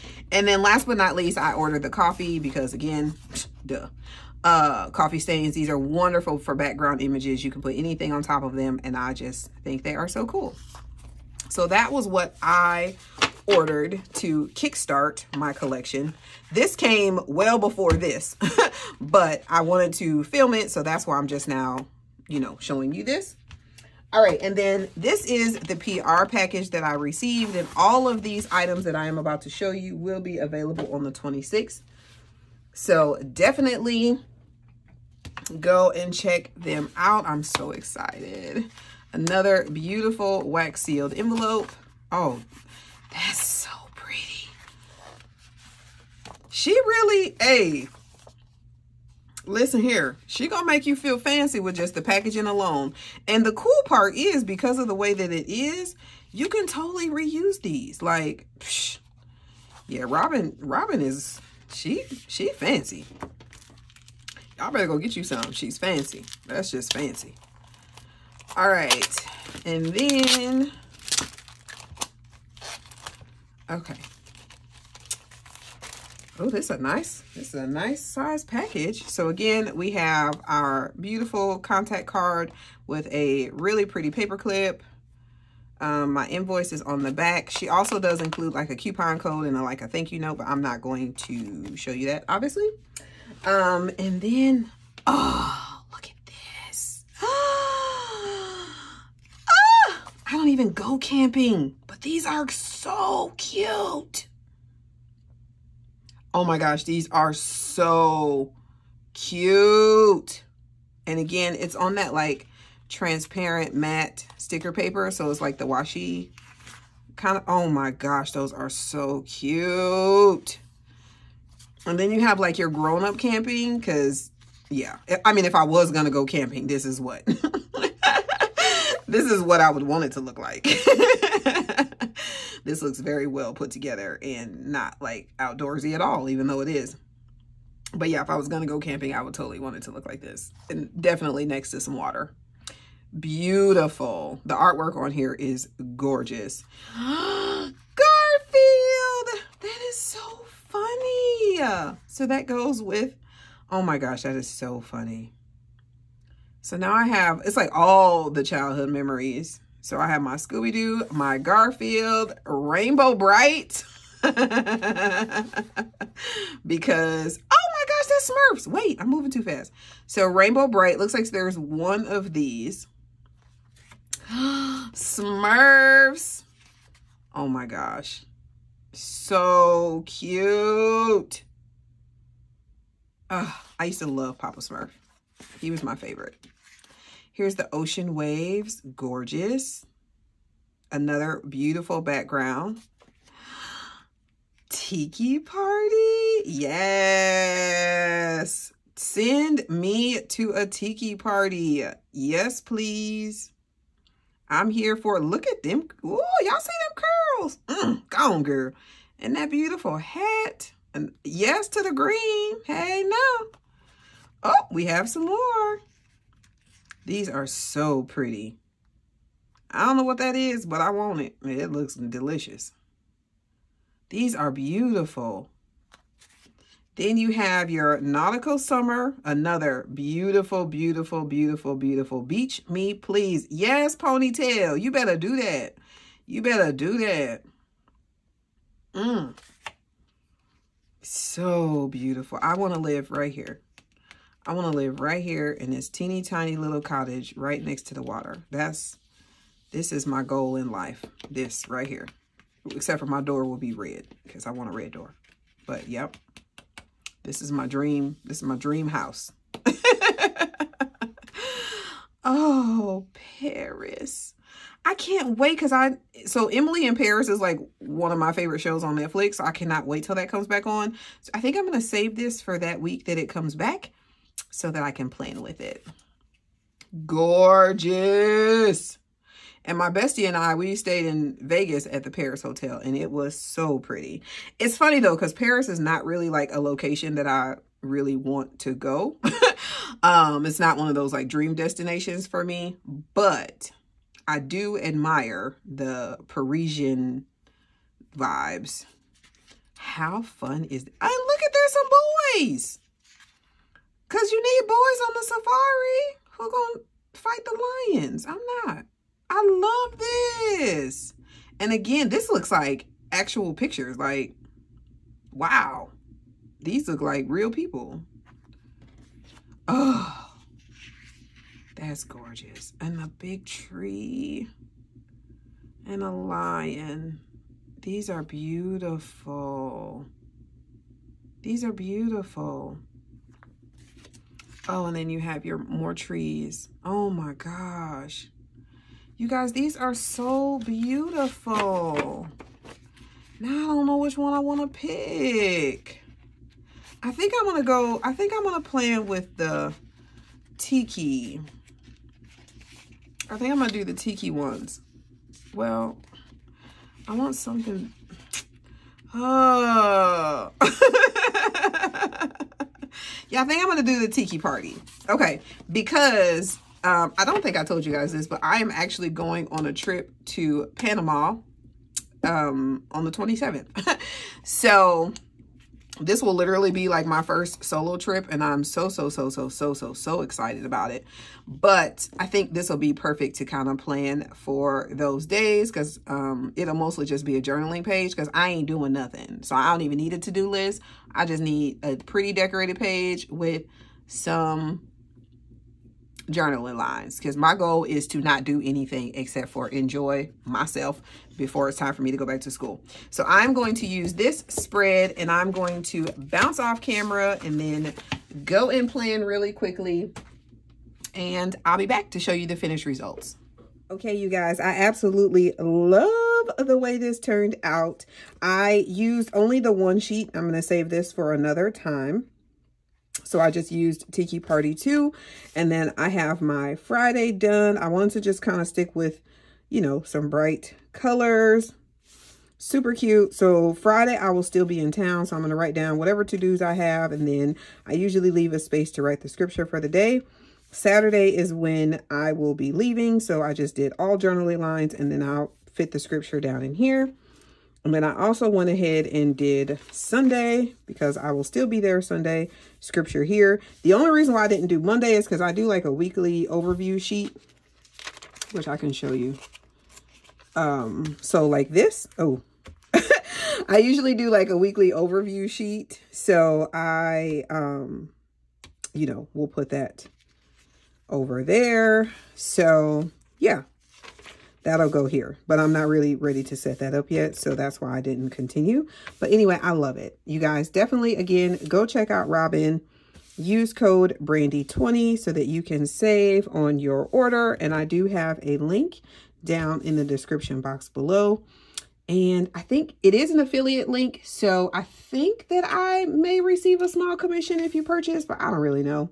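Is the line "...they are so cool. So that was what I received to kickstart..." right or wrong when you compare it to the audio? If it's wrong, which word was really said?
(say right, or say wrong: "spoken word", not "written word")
wrong: "ordered", not "received".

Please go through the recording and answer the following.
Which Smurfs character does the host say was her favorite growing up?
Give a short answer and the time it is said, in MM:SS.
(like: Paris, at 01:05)
Papa Smurf, at 03:04.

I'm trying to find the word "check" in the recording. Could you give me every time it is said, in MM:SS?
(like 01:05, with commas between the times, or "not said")
00:36, 08:01.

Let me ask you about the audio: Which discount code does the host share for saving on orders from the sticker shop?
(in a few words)
BRANDY20.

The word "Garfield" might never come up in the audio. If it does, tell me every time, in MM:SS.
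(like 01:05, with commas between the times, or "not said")
02:26, 02:41.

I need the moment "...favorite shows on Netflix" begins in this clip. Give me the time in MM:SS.
04:28.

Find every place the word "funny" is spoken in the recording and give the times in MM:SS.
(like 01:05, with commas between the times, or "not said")
02:30, 02:34, 04:44.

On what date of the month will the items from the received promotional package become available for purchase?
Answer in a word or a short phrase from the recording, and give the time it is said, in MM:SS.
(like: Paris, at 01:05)
26th, at 00:31.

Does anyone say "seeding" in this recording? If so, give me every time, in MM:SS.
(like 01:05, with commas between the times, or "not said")
not said.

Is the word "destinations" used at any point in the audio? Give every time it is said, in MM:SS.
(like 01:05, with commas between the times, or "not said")
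04:51.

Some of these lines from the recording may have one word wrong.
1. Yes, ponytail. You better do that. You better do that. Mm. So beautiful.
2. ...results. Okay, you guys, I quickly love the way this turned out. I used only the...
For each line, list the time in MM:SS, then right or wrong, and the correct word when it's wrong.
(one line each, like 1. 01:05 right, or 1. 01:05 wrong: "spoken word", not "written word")
1. 03:53 right
2. 06:52 wrong: "absolutely", not "quickly".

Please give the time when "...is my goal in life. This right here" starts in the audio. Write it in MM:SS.
04:09.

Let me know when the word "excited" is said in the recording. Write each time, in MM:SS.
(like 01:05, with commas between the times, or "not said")
00:37, 06:20.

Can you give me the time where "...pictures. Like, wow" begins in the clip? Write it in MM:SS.
05:13.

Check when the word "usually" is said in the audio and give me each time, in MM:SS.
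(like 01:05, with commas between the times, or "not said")
07:17, 07:43.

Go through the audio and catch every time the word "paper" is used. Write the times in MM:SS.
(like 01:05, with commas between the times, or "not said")
01:24, 01:54.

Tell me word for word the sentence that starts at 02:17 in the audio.
But yeah, if I was going to go camping, I would totally want it to look like this.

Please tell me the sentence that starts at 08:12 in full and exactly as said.
And I think it is an affiliate link.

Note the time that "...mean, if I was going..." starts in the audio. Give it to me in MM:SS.
02:05.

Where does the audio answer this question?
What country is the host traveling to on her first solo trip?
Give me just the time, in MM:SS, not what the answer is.
06:10.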